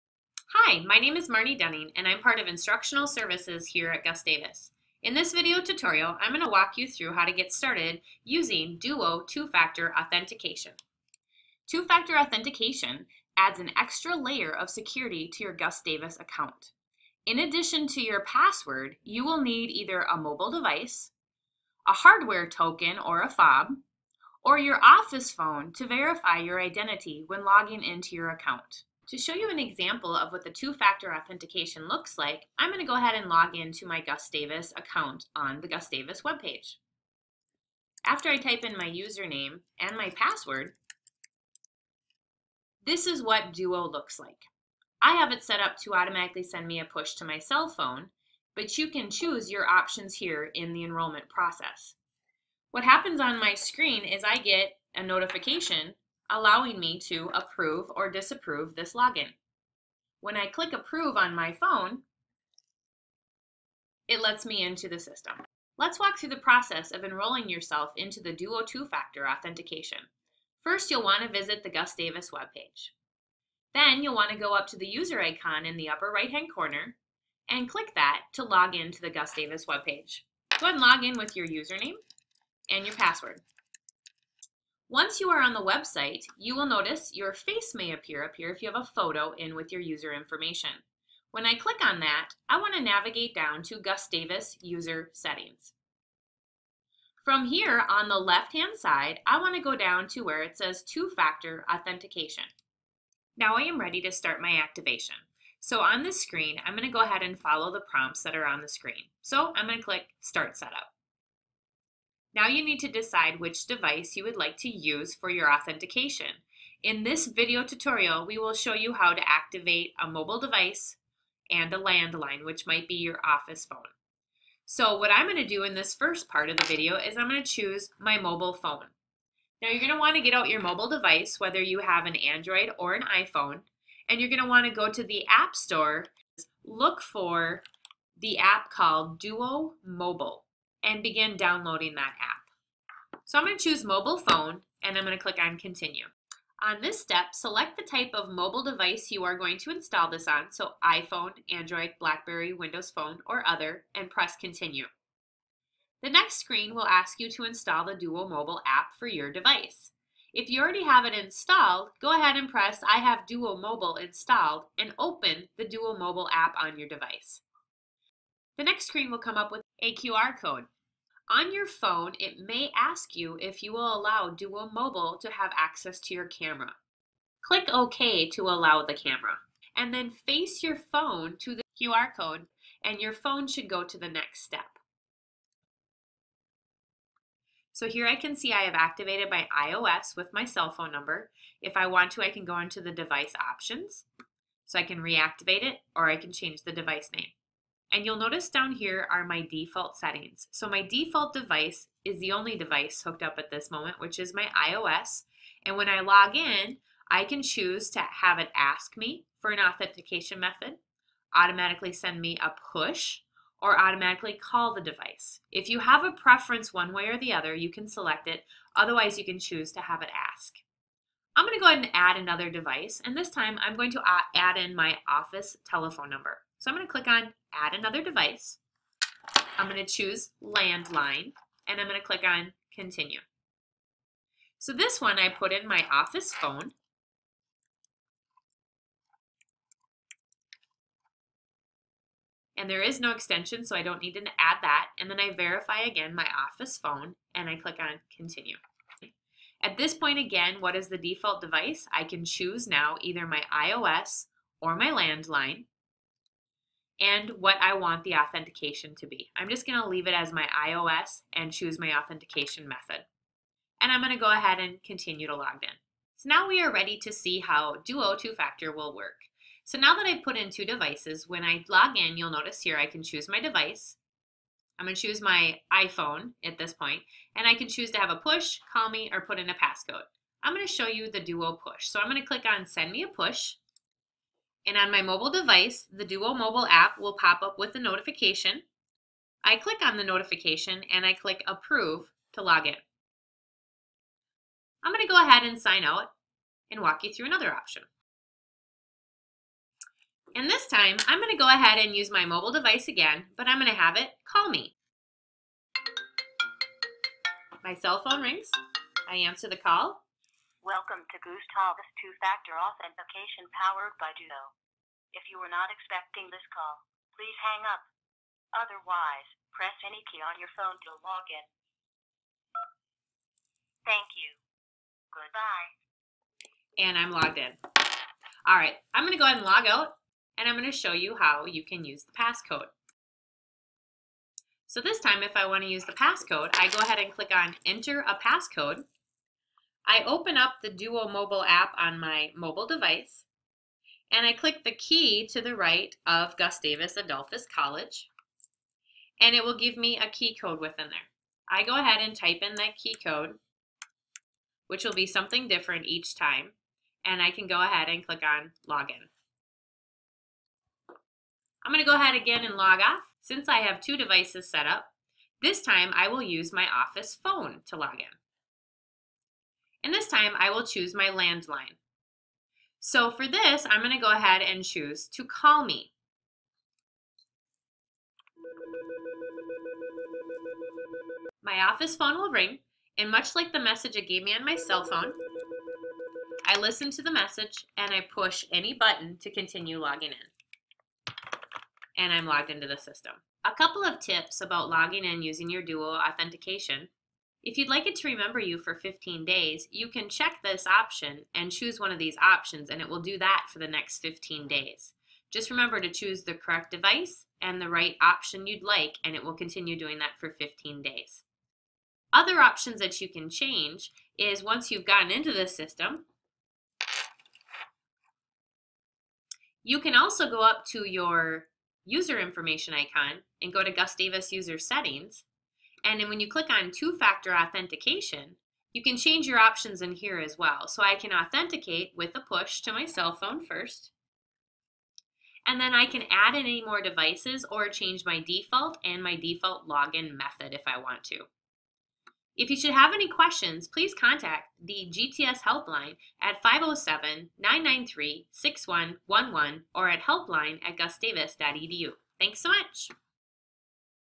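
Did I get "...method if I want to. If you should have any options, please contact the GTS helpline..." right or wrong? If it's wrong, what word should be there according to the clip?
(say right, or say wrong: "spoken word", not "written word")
wrong: "questions", not "options".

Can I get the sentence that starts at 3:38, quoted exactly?
Otherwise, you can choose to have it ask.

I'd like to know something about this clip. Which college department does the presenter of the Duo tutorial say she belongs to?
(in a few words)
Instructional Services.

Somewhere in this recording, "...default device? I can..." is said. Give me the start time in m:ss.
4:10.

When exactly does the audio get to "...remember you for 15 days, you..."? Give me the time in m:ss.
6:38.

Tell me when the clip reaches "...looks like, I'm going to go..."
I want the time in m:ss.
0:31.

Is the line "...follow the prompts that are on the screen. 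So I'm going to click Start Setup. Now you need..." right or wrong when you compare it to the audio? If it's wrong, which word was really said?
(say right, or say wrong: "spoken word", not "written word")
right.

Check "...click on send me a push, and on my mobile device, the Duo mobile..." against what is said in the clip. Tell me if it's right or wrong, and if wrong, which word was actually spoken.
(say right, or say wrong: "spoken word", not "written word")
right.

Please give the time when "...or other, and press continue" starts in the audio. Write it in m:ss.
2:33.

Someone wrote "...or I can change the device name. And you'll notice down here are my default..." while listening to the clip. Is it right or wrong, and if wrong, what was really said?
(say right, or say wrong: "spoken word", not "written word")
right.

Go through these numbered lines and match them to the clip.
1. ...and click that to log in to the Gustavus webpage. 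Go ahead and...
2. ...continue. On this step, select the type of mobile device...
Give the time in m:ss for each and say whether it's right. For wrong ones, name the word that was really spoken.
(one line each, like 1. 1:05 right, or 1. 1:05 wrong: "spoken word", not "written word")
1. 1:17 right
2. 2:25 right.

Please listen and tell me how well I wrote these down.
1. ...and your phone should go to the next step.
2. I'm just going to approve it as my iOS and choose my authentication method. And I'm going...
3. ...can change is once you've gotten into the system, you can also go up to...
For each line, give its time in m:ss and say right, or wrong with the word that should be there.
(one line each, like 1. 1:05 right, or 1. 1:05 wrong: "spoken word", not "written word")
1. 3:02 right
2. 4:19 wrong: "leave", not "approve"
3. 6:53 right.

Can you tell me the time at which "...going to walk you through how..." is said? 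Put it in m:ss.
0:06.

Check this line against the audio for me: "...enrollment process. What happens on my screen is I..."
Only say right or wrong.
right.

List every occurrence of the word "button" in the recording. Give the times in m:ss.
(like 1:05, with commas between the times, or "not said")
6:28.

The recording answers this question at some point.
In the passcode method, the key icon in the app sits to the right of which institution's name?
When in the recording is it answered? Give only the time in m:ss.
5:46.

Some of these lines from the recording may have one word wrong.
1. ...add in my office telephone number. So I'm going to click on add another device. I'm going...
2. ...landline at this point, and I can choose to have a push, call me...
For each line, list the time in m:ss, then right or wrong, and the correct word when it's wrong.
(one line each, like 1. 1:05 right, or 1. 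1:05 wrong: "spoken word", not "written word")
1. 3:44 right
2. 4:35 wrong: "iPhone", not "landline".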